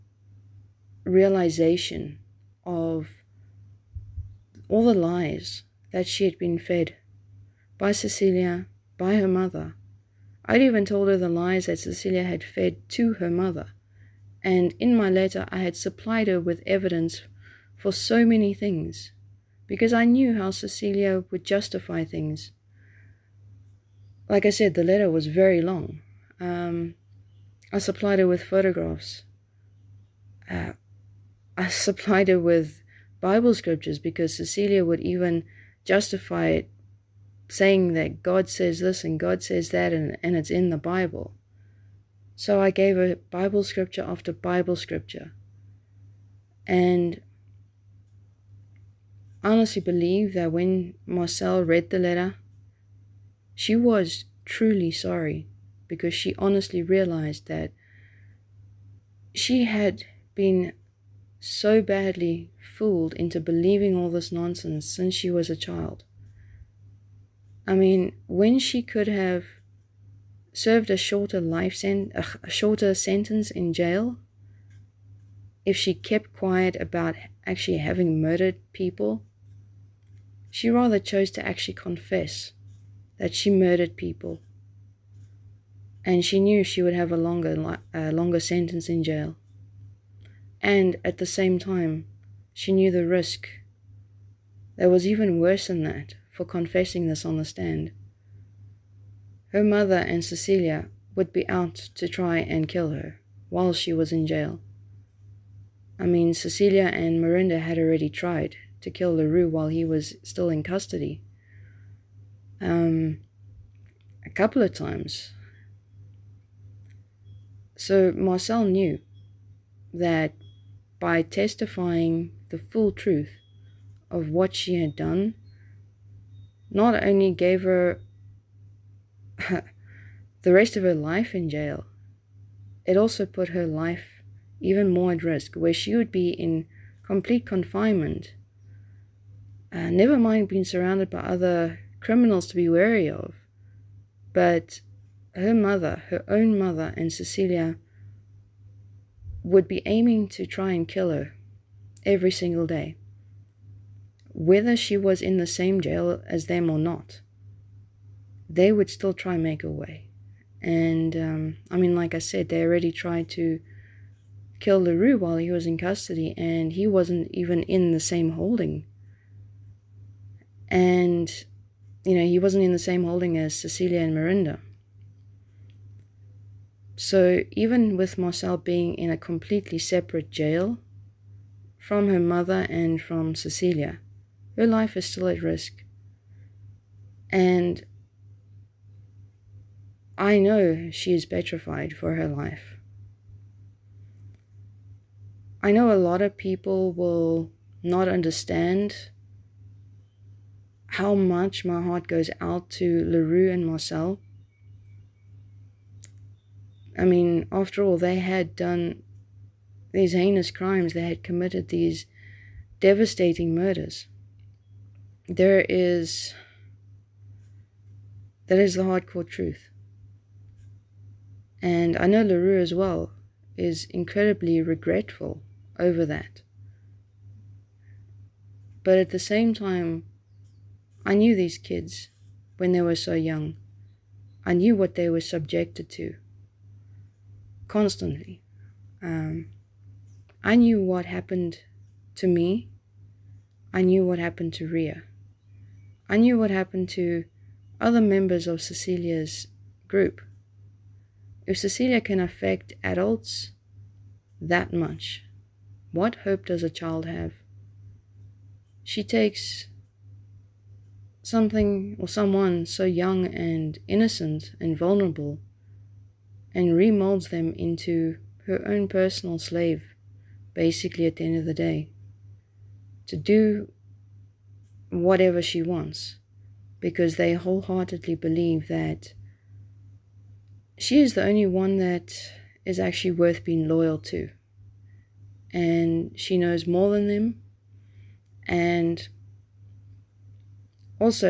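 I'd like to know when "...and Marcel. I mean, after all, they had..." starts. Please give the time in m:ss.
3:23.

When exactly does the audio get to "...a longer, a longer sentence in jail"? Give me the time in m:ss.
1:27.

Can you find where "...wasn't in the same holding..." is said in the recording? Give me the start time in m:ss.
2:52.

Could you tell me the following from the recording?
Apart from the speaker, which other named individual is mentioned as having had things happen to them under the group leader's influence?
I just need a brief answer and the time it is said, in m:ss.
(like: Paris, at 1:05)
Ria, at 4:04.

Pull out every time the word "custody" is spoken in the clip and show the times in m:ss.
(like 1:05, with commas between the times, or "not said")
1:50, 2:45.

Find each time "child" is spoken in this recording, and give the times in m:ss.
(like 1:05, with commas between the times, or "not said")
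1:05, 4:16.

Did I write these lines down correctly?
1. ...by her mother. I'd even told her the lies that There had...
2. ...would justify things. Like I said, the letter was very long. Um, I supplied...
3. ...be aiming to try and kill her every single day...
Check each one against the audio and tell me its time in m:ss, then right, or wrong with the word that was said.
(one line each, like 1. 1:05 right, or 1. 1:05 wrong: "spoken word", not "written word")
1. 0:08 wrong: "Cecilia", not "There"
2. 0:21 right
3. 2:29 right.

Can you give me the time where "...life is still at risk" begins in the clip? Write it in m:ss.
3:04.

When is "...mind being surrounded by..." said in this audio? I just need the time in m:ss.
2:20.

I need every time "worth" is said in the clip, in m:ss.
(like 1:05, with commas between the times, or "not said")
4:43.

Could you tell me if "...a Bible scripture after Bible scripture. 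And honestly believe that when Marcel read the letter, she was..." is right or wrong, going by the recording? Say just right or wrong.
right.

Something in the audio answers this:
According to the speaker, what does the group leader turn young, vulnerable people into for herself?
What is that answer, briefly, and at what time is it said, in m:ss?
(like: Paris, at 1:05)
personal slave, at 4:28.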